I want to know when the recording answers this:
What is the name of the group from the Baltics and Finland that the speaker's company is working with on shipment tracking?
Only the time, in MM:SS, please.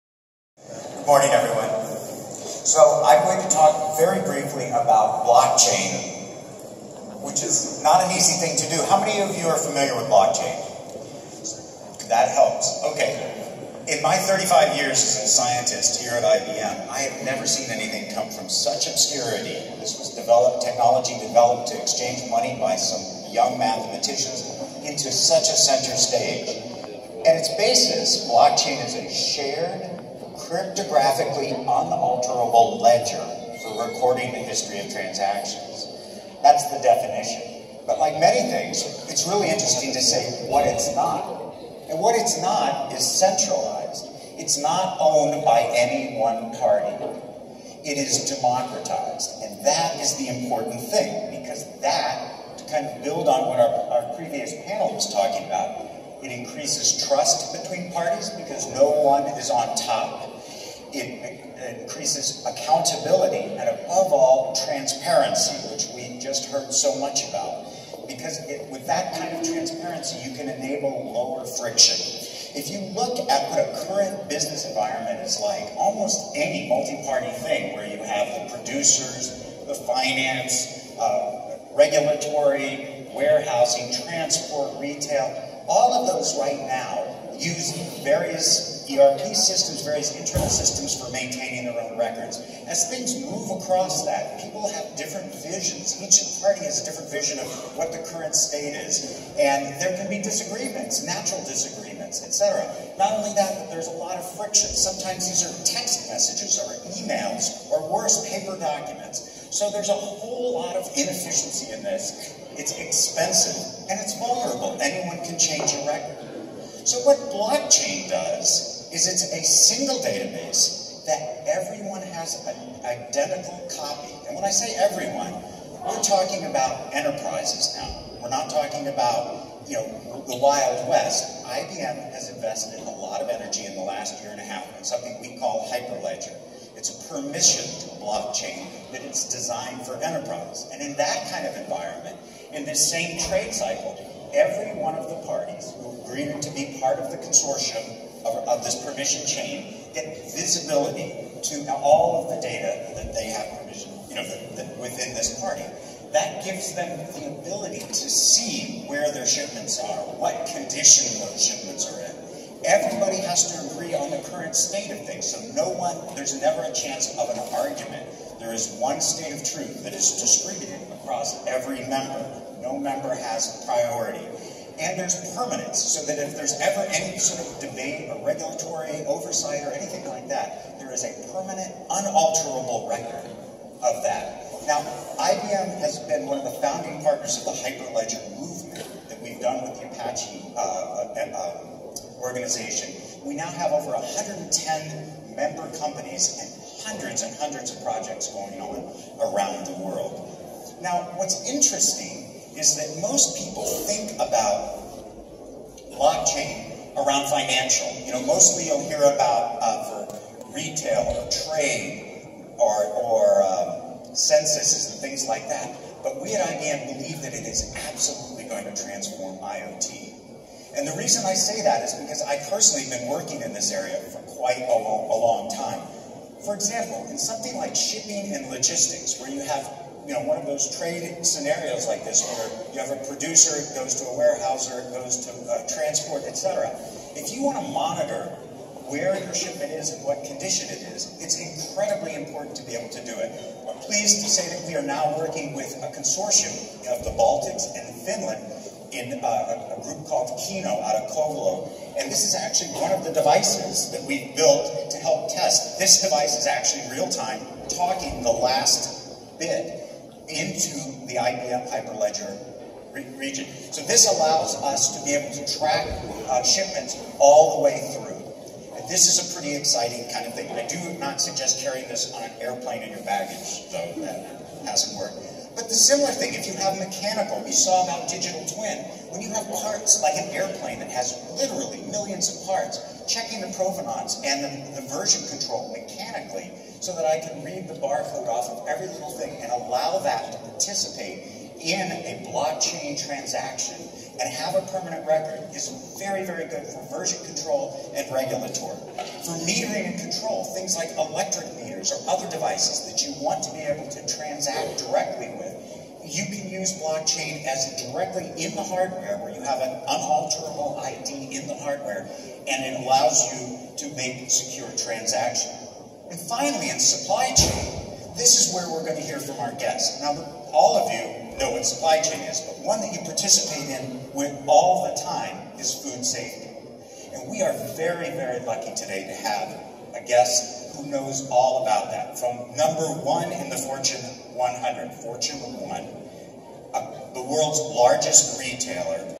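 04:10.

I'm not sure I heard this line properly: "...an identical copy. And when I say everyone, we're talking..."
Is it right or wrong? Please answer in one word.
right.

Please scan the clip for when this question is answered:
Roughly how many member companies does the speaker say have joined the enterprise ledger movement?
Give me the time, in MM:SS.
03:13.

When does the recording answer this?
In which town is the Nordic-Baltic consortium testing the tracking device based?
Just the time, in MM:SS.
04:11.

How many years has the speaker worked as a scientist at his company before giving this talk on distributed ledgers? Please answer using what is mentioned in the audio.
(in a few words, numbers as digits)
35.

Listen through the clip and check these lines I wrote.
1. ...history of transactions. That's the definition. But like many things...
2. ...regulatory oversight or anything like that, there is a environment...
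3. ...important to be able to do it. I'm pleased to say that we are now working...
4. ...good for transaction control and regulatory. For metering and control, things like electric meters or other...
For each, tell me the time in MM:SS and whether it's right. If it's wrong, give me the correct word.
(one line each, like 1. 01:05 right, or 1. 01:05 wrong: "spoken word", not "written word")
1. 00:34 right
2. 02:58 wrong: "permanent", not "environment"
3. 04:02 right
4. 04:56 wrong: "version", not "transaction".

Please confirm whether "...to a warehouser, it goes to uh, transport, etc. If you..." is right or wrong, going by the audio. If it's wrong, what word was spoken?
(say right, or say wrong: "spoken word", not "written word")
right.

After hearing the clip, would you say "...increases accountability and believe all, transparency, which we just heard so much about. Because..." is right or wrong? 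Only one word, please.
wrong.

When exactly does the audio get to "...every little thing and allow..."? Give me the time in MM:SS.
04:48.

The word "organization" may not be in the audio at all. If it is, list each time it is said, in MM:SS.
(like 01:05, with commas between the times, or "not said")
03:12.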